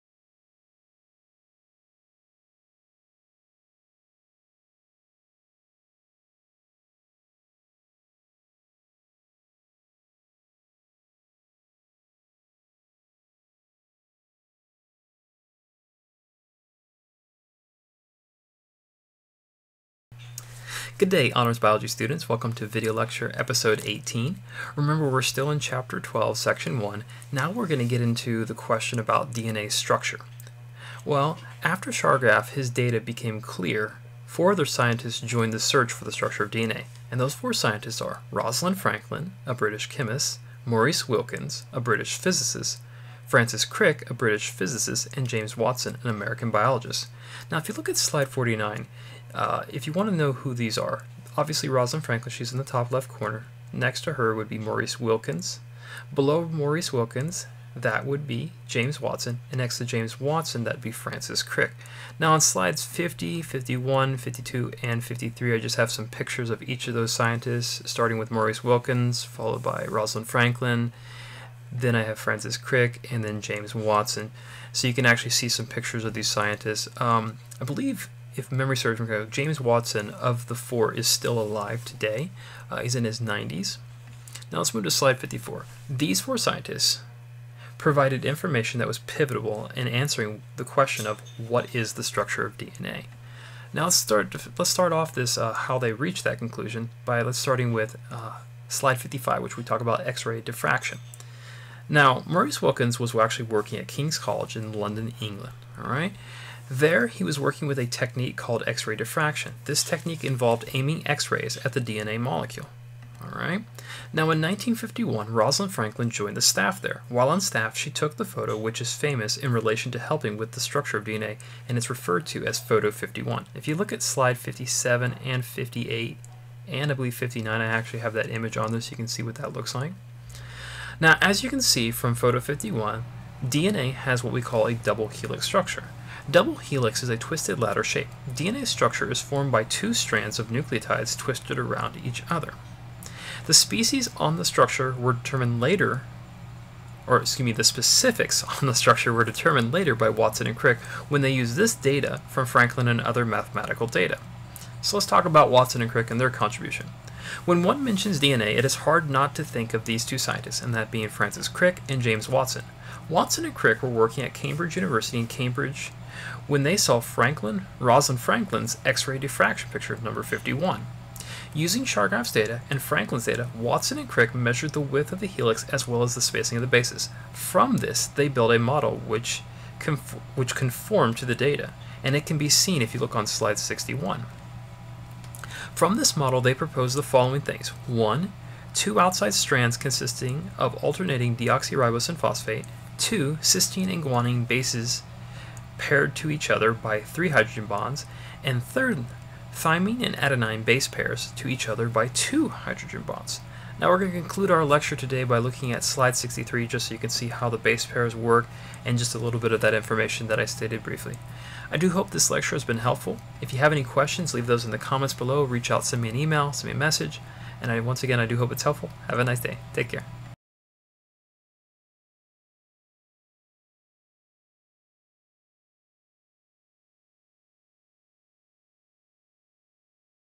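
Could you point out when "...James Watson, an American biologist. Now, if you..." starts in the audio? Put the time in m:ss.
0:45.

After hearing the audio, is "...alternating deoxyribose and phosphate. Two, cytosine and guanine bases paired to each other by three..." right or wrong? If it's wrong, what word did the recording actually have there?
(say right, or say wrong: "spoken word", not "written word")
right.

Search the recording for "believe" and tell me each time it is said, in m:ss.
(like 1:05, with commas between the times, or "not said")
1:17, 2:06.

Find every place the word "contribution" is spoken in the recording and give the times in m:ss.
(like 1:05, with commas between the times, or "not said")
2:36.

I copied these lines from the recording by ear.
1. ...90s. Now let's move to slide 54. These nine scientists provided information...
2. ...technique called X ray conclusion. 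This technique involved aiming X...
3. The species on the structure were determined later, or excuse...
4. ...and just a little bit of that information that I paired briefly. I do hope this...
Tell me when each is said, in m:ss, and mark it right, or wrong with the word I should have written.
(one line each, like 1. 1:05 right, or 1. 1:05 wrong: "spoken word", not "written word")
1. 1:23 wrong: "four", not "nine"
2. 1:47 wrong: "diffraction", not "conclusion"
3. 2:23 right
4. 3:28 wrong: "stated", not "paired".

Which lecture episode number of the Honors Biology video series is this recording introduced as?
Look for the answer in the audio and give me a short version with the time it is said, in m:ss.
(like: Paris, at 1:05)
18, at 0:23.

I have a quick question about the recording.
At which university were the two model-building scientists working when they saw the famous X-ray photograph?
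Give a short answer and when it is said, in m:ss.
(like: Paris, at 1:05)
Cambridge University, at 2:44.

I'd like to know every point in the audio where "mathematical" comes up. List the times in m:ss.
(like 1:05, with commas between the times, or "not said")
2:33.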